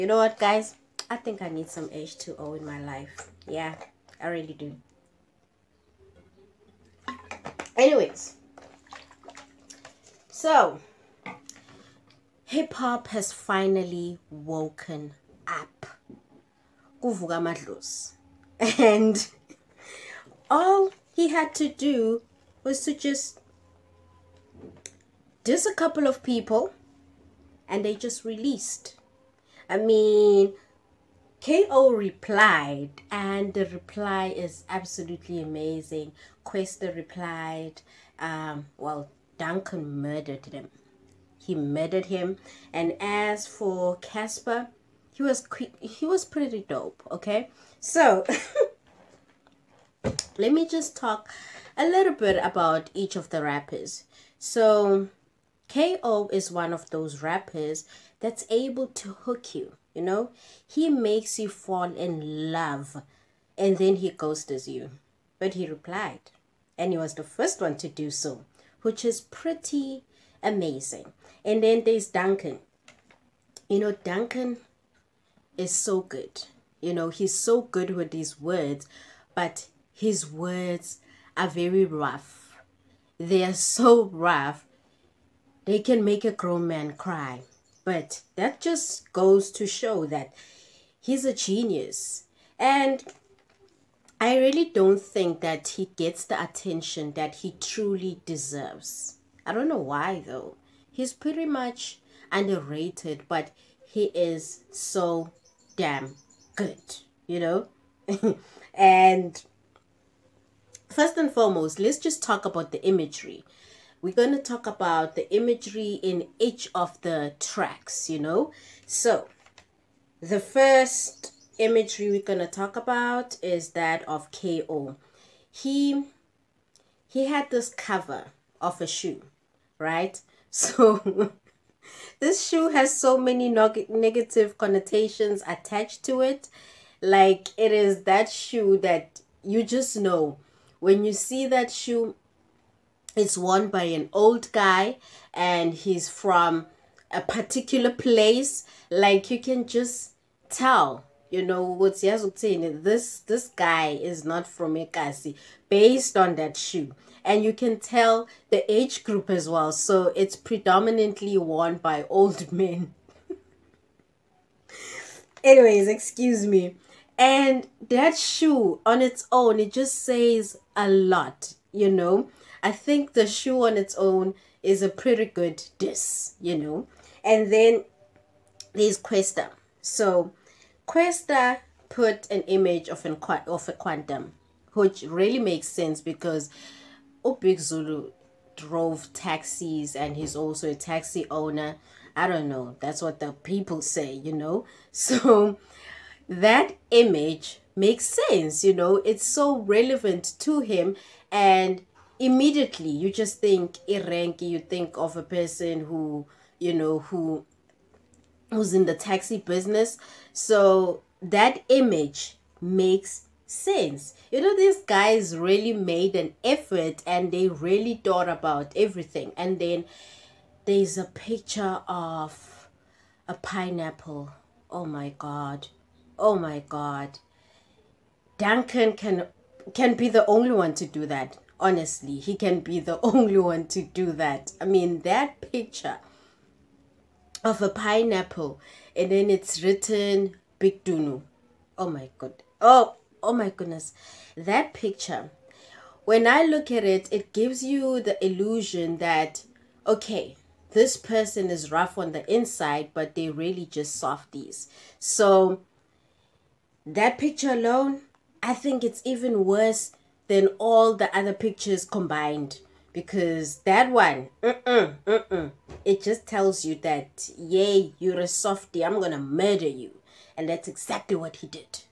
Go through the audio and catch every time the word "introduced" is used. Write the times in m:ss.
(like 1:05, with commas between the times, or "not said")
not said.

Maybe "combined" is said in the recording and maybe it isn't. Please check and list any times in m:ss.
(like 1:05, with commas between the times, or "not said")
4:21.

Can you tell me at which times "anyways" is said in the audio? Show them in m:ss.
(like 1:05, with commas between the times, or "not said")
0:07, 2:45.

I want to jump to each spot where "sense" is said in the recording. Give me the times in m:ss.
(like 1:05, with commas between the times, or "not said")
3:05, 3:18, 3:33.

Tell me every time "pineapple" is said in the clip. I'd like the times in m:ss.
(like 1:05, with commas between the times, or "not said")
3:43, 3:57.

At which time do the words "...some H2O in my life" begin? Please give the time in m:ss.
0:01.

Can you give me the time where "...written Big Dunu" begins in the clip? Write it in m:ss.
3:59.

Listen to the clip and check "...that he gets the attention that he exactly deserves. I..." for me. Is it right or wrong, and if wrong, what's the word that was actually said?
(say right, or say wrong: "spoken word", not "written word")
wrong: "truly", not "exactly".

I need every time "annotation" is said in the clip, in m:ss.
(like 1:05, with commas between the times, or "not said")
not said.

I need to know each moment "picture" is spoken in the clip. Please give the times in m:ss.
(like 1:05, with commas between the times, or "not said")
3:41, 3:55, 4:04, 4:17, 4:21.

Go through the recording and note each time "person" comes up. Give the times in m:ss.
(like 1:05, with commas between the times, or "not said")
3:25, 4:10.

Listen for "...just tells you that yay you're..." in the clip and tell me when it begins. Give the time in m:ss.
4:26.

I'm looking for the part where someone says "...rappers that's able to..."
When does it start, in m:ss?
0:57.